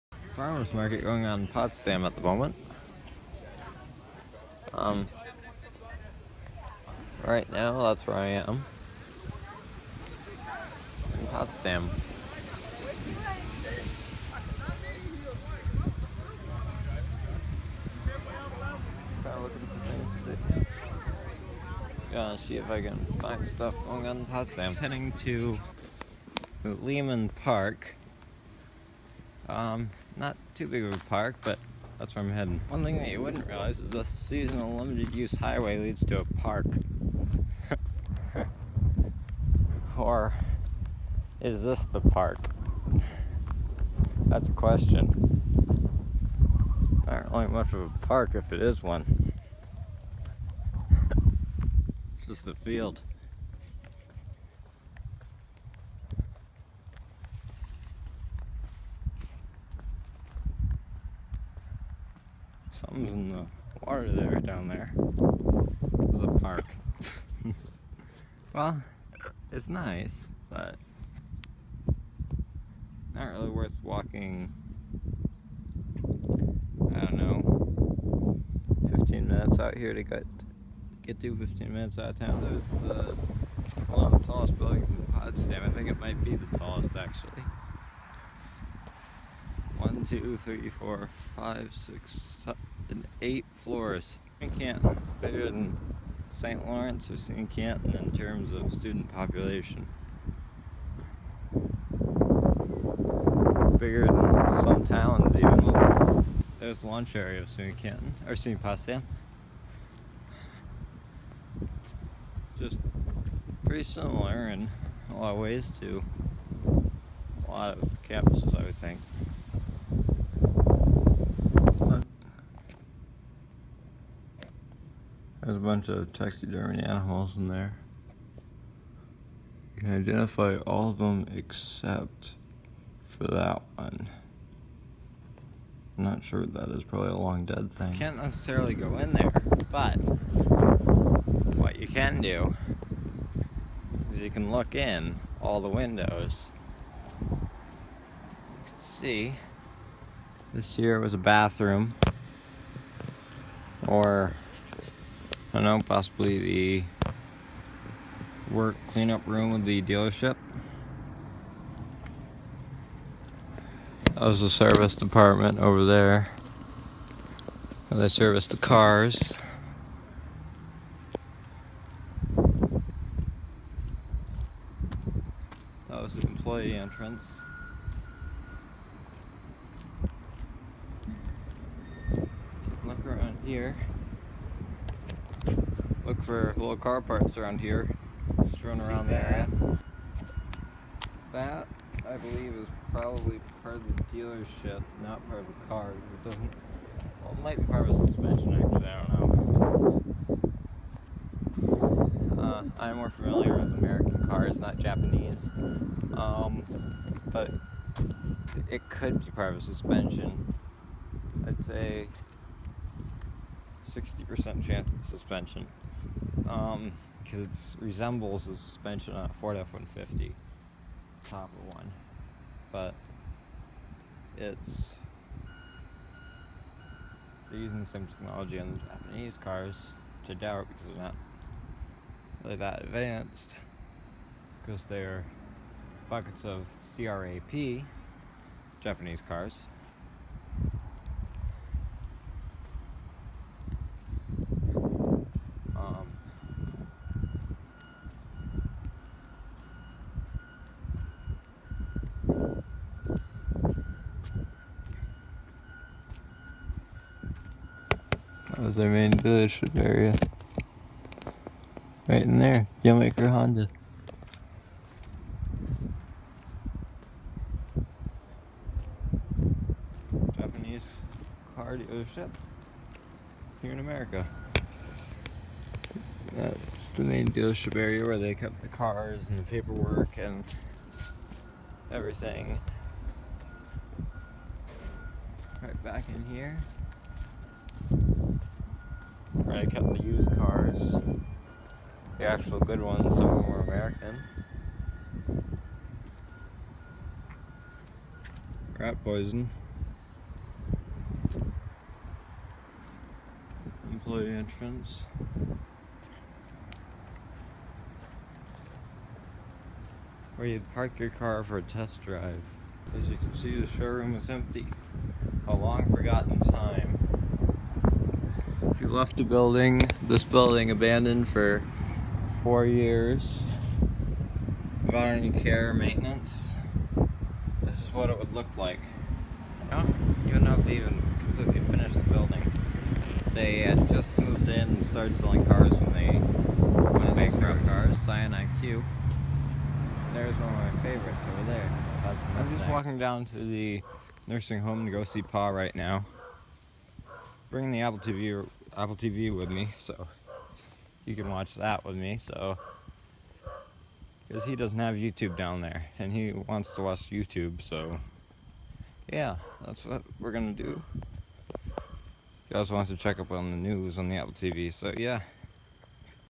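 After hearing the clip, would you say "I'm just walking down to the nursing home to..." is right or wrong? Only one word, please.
right.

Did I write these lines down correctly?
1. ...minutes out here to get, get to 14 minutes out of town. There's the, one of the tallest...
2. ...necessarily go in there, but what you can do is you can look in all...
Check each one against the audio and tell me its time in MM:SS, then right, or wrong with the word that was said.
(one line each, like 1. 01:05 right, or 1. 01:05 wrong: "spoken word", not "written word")
1. 01:19 wrong: "15", not "14"
2. 02:18 right.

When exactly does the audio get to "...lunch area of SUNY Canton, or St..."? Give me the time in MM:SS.
01:46.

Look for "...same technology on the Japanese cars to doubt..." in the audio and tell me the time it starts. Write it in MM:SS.
03:47.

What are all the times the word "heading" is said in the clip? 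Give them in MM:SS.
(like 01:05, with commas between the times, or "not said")
00:24, 00:32.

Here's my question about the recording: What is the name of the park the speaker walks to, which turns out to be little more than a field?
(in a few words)
Lehman Park.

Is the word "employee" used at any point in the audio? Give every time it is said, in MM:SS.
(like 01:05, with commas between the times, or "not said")
02:56, 05:03.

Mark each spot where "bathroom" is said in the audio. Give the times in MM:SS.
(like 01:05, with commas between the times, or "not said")
02:31.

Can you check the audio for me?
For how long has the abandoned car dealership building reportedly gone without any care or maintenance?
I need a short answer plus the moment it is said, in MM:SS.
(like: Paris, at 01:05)
4 years, at 05:22.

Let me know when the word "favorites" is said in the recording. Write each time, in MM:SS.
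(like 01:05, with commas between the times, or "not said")
05:40.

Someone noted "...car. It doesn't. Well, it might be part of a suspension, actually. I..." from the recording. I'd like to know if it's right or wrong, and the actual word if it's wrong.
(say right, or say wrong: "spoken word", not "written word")
right.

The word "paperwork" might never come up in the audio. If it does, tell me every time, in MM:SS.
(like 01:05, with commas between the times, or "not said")
04:39.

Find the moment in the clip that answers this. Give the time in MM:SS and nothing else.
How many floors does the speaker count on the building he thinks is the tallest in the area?
01:33.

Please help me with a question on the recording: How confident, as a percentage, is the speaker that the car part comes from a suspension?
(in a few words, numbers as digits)
60%.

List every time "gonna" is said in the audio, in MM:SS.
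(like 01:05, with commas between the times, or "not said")
00:22, 06:00.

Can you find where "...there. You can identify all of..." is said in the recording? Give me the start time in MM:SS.
02:07.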